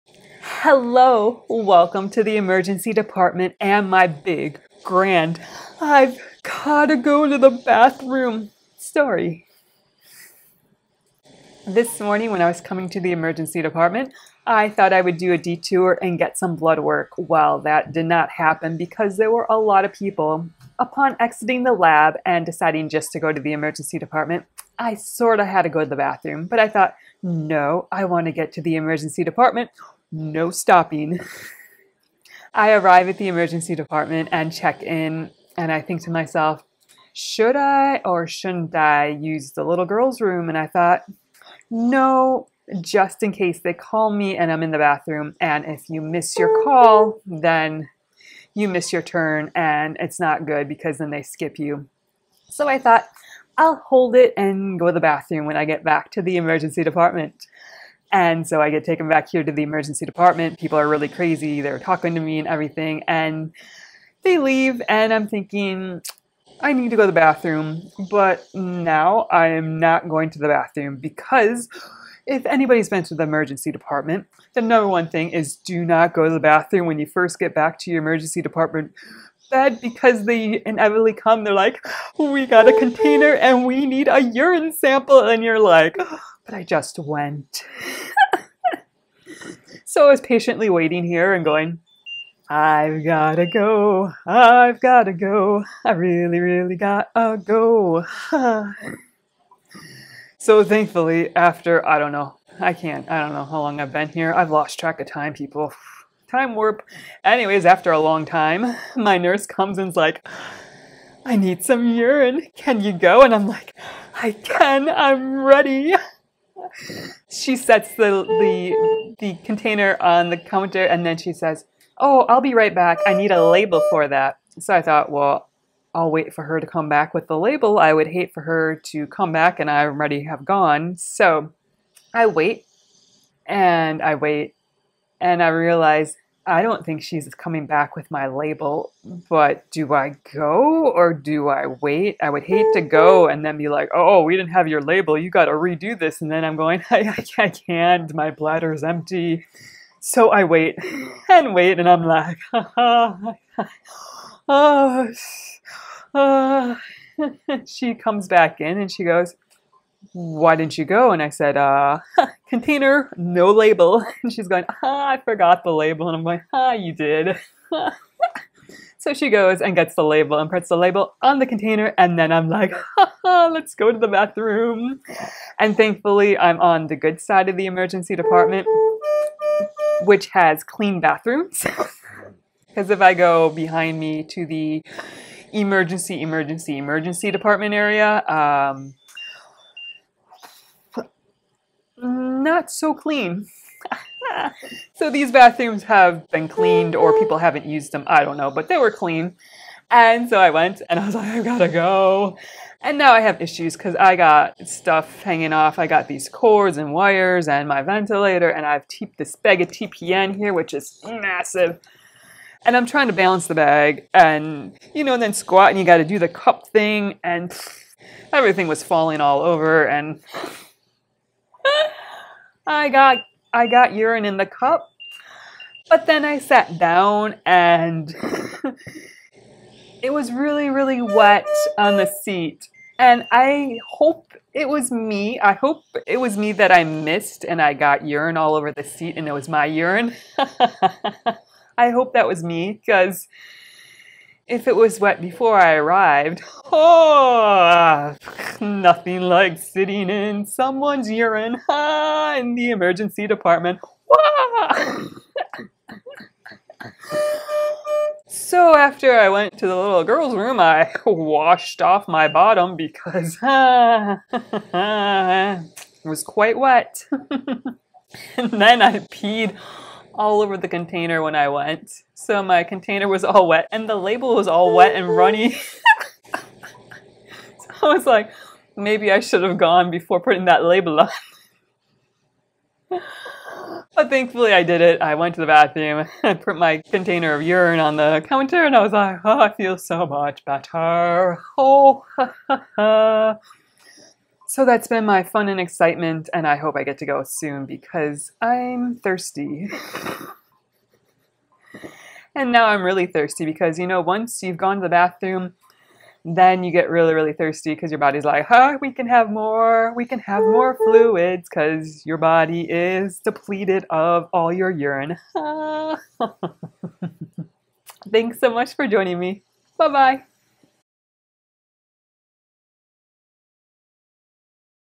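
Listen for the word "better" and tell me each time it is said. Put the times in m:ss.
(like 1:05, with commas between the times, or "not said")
4:50.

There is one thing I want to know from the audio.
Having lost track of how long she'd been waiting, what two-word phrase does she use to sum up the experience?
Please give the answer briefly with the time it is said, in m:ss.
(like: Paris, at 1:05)
Time warp, at 1:46.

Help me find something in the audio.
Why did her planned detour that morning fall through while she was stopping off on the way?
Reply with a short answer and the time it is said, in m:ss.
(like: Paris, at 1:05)
A lot of people, at 0:19.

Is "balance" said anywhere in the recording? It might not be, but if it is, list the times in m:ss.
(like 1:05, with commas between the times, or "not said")
3:33.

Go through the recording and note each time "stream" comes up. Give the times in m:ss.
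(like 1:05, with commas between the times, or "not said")
not said.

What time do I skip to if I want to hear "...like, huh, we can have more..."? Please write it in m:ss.
5:08.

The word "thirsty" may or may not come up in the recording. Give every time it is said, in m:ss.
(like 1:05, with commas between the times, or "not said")
4:58, 5:03, 5:07.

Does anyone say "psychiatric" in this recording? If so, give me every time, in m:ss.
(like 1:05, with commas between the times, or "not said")
not said.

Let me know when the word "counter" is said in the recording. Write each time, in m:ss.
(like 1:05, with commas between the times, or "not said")
2:00, 4:48.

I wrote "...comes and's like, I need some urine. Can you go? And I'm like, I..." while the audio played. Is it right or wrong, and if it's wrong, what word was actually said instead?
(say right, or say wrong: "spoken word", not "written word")
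right.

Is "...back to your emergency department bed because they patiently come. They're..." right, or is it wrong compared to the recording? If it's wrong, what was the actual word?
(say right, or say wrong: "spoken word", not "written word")
wrong: "inevitably", not "patiently".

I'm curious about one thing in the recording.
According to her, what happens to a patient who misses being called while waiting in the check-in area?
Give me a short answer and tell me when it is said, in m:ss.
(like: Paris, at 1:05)
They skip you, at 0:51.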